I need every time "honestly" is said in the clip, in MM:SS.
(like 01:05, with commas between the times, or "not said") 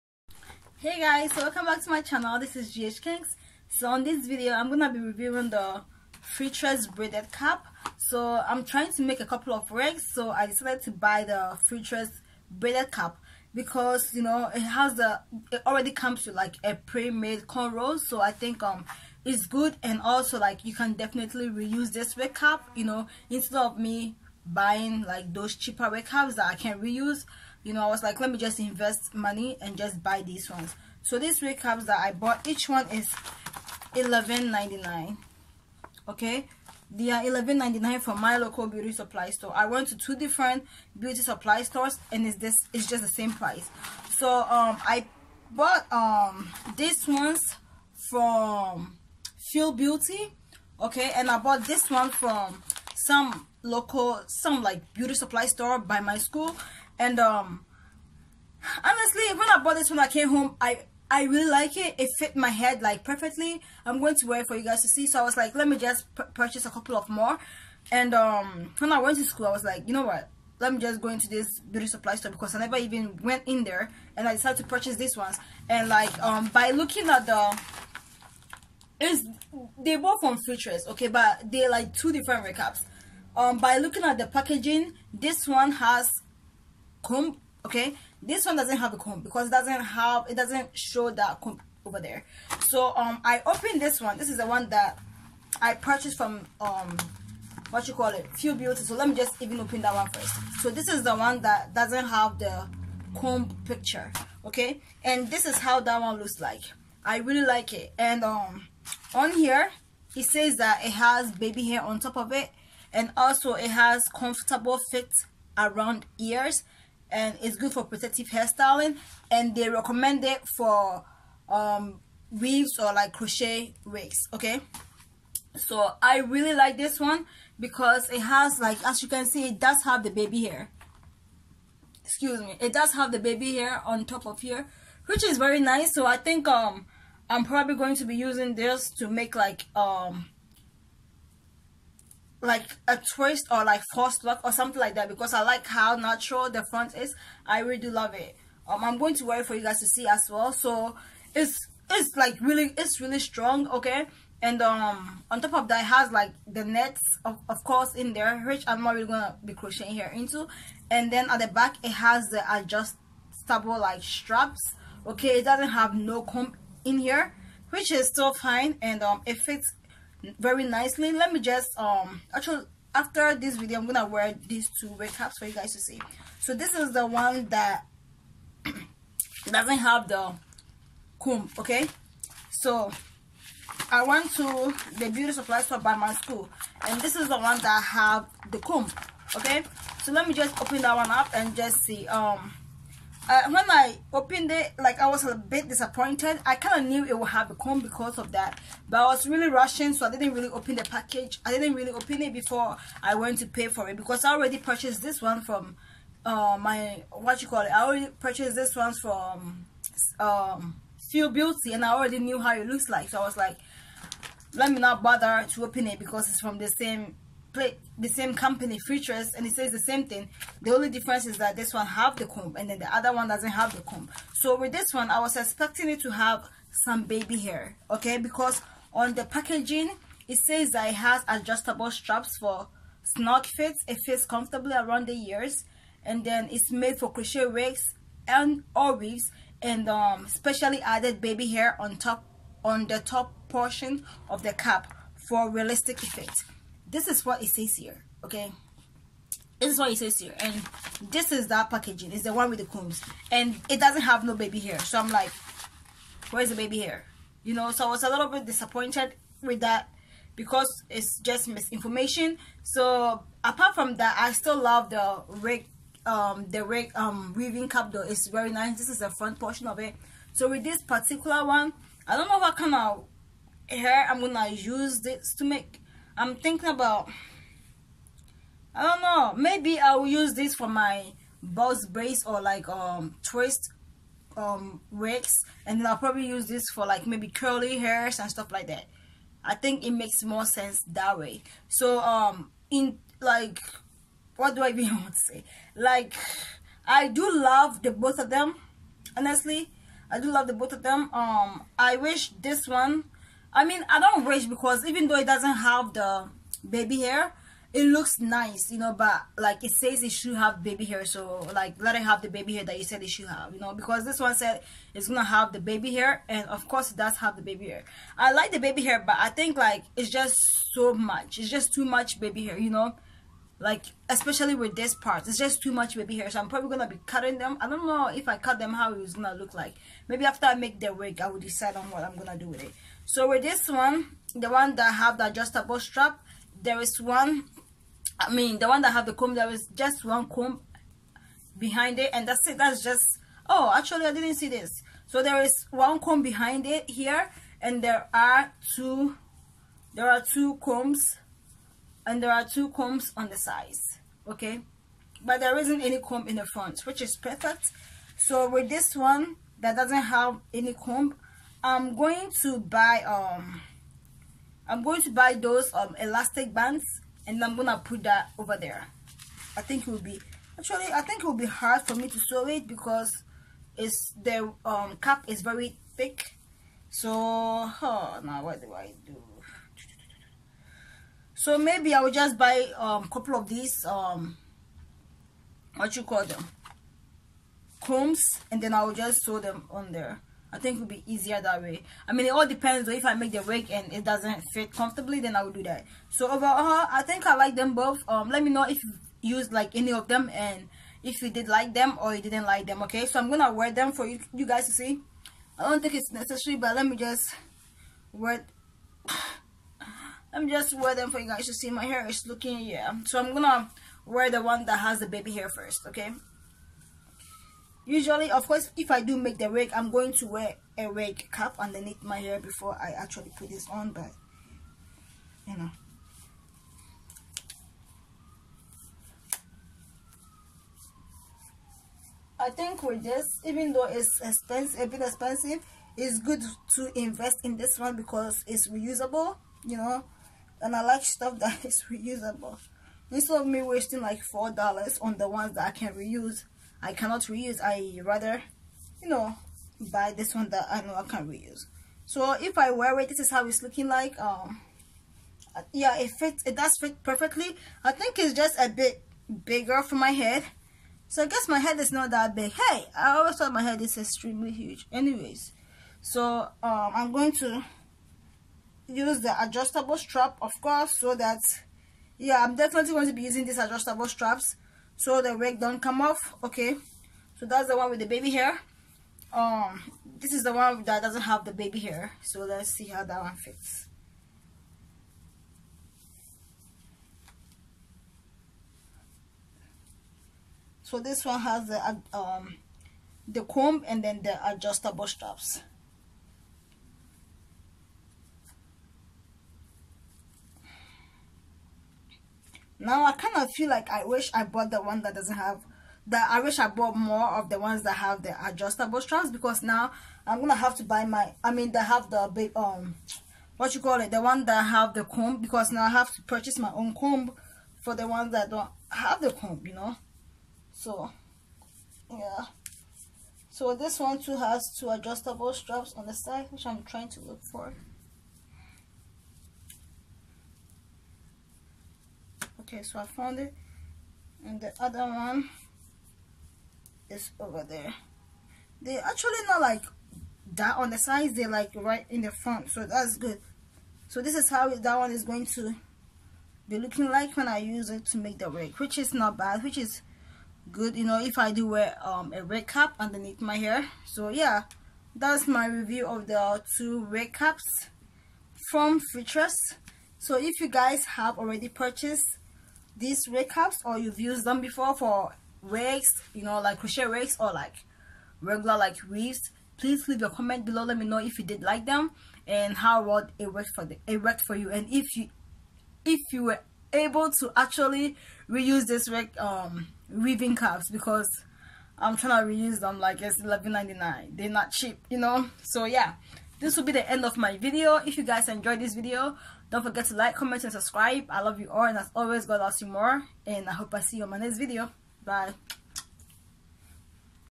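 00:58, 04:59.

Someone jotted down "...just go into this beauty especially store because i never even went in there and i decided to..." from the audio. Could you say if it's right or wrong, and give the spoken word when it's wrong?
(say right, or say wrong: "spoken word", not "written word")
wrong: "supply", not "especially".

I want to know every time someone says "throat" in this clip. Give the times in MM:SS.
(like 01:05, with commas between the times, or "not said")
not said.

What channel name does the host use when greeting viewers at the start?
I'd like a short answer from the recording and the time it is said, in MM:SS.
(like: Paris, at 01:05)
GH Kinks, at 00:02.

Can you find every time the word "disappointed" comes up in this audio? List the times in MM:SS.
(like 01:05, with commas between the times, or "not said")
03:15, 04:18.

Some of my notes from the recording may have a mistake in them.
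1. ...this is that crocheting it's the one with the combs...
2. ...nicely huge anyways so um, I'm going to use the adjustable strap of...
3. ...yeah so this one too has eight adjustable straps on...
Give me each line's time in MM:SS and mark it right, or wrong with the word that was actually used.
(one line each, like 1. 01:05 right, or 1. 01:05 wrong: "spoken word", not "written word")
1. 04:11 wrong: "packaging", not "crocheting"
2. 07:43 wrong: "extremely", not "nicely"
3. 08:42 wrong: "two", not "eight".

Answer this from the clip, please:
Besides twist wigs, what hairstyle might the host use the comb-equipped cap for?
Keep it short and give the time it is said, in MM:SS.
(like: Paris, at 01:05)
box braids, at 04:41.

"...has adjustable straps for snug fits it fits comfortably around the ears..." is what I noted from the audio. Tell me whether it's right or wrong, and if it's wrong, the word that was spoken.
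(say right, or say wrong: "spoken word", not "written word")
right.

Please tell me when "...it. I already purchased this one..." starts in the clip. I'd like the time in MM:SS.
03:27.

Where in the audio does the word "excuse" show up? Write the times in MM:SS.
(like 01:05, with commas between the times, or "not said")
02:12.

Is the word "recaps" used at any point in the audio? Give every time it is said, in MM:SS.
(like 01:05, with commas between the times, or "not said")
01:22, 02:54, 09:23.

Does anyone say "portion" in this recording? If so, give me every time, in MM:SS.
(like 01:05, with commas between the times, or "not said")
04:03, 04:29.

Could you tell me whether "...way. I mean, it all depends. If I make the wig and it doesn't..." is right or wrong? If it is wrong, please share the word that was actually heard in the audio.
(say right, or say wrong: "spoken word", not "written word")
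right.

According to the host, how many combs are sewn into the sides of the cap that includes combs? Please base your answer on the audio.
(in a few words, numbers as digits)
2.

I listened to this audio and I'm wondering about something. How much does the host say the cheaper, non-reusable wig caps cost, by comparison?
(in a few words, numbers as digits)
$4.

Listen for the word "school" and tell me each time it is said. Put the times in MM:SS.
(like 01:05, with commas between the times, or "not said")
00:56, 01:09, 03:06.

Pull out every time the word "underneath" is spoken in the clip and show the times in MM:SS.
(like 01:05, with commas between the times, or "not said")
07:01, 09:12.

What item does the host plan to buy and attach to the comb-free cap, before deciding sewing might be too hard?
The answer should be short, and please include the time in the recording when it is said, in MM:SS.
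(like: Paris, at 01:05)
elastic bands, at 06:05.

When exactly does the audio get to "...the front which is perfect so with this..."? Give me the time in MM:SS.
05:56.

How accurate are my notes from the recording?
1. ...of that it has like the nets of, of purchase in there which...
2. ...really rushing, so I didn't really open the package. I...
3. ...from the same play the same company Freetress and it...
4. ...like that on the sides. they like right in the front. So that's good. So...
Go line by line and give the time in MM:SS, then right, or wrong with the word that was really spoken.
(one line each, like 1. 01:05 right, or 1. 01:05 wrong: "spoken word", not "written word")
1. 02:35 wrong: "course", not "purchase"
2. 03:19 right
3. 03:36 right
4. 08:59 right.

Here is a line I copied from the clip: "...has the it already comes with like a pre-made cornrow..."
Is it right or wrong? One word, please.
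right.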